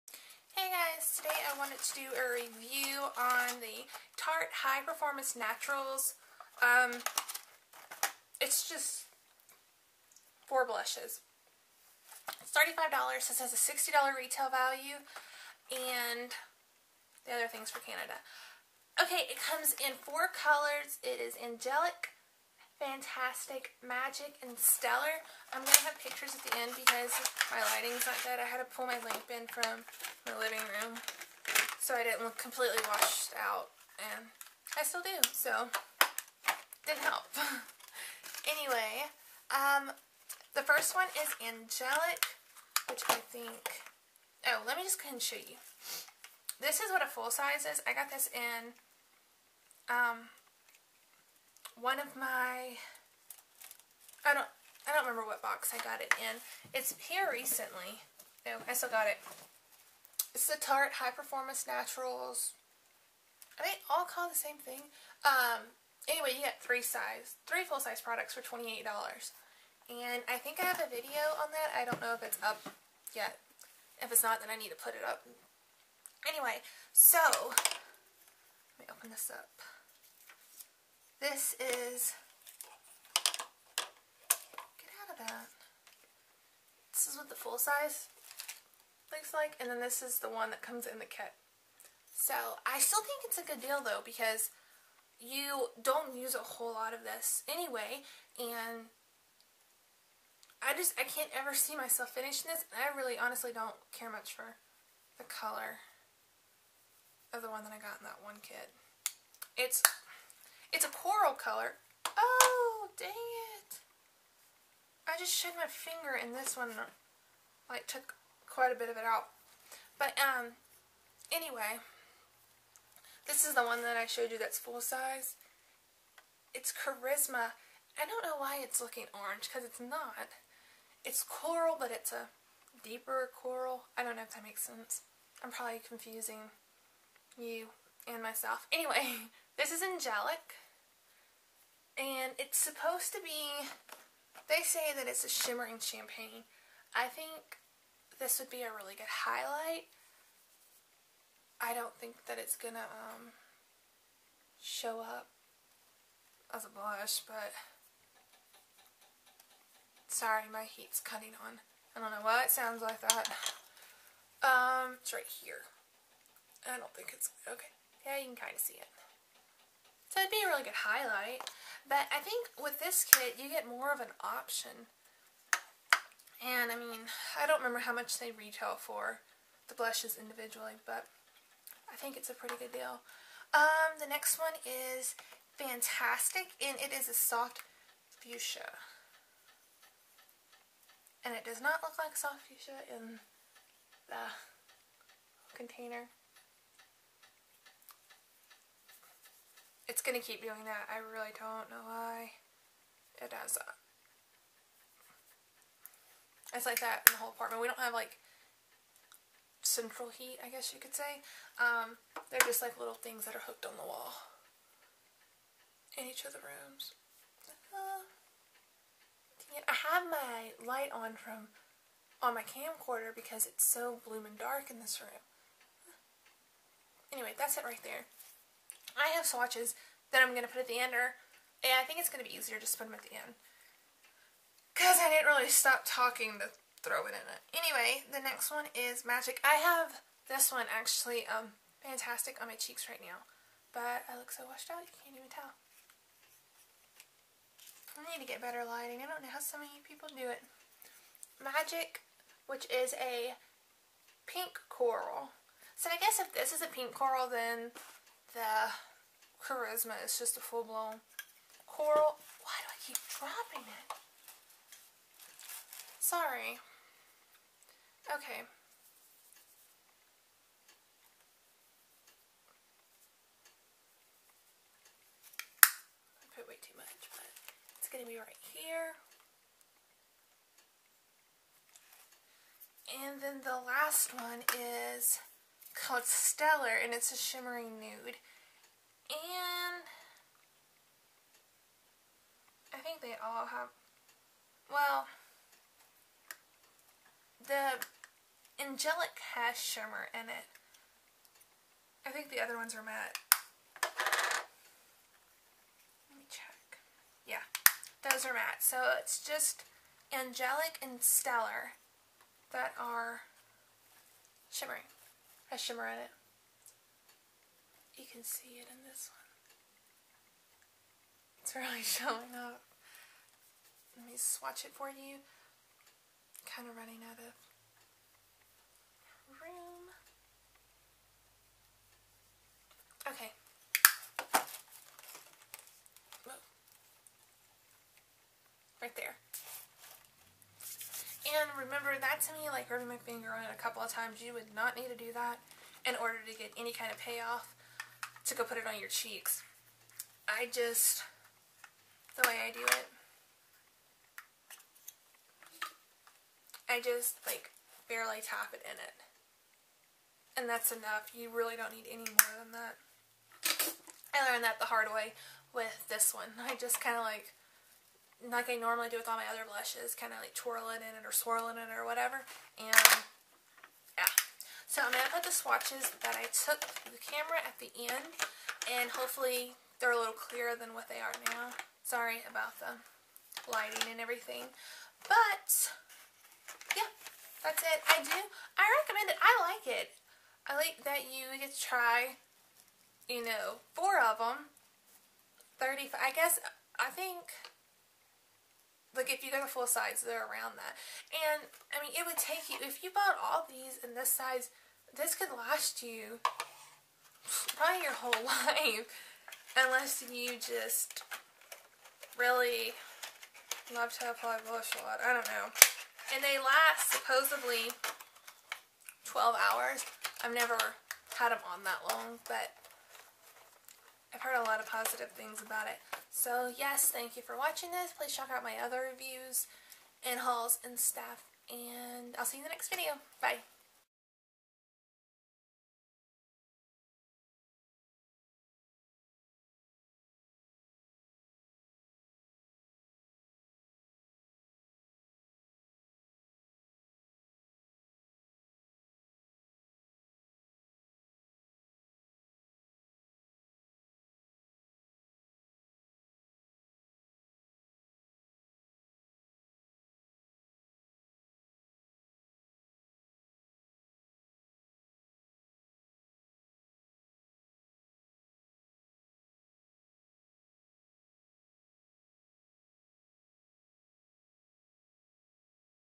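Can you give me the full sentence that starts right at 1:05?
Um, anyway, you get three size, three full-size products for $28.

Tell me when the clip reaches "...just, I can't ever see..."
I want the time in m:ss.
1:40.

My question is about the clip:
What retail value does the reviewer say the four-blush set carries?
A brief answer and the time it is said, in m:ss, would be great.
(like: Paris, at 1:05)
$60, at 0:13.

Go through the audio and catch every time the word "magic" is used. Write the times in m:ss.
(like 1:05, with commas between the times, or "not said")
0:23, 3:59, 4:11.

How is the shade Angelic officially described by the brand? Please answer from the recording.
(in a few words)
shimmering champagne.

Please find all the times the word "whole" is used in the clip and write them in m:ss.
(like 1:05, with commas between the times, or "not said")
1:36, 3:27, 6:47.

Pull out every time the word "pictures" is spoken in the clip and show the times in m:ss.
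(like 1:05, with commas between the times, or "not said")
0:26.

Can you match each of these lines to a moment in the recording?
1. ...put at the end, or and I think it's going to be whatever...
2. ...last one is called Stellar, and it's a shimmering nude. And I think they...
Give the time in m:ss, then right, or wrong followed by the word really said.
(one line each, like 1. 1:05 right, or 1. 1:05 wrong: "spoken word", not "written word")
1. 3:50 wrong: "easier", not "whatever"
2. 4:43 right.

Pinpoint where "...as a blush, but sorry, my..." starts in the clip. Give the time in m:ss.
2:36.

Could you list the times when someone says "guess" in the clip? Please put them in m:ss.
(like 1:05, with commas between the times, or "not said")
3:30, 4:16, 6:36.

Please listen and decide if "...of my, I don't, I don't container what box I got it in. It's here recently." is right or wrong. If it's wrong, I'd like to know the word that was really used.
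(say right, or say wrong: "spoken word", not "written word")
wrong: "remember", not "container".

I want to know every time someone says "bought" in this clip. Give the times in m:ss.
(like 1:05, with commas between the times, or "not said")
6:42.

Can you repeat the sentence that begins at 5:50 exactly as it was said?
I just, the way I do it, I just like barely tap it in it.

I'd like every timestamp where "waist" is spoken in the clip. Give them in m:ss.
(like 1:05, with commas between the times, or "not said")
not said.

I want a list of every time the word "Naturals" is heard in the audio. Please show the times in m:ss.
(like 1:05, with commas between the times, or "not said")
0:05, 1:01.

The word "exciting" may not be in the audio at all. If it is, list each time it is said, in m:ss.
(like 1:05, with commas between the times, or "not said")
not said.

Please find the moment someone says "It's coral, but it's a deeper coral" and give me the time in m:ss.
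2:11.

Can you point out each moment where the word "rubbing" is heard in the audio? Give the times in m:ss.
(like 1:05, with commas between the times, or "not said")
5:42.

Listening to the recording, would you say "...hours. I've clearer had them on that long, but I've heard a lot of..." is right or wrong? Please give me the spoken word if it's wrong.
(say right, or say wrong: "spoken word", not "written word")
wrong: "never", not "clearer".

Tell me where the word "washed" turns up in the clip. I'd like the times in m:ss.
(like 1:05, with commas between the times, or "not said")
0:32, 4:04.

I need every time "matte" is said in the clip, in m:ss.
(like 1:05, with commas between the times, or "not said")
5:02, 5:08.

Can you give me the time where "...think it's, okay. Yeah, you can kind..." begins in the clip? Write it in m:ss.
2:46.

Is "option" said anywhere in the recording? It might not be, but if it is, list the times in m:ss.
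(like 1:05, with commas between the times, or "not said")
2:54.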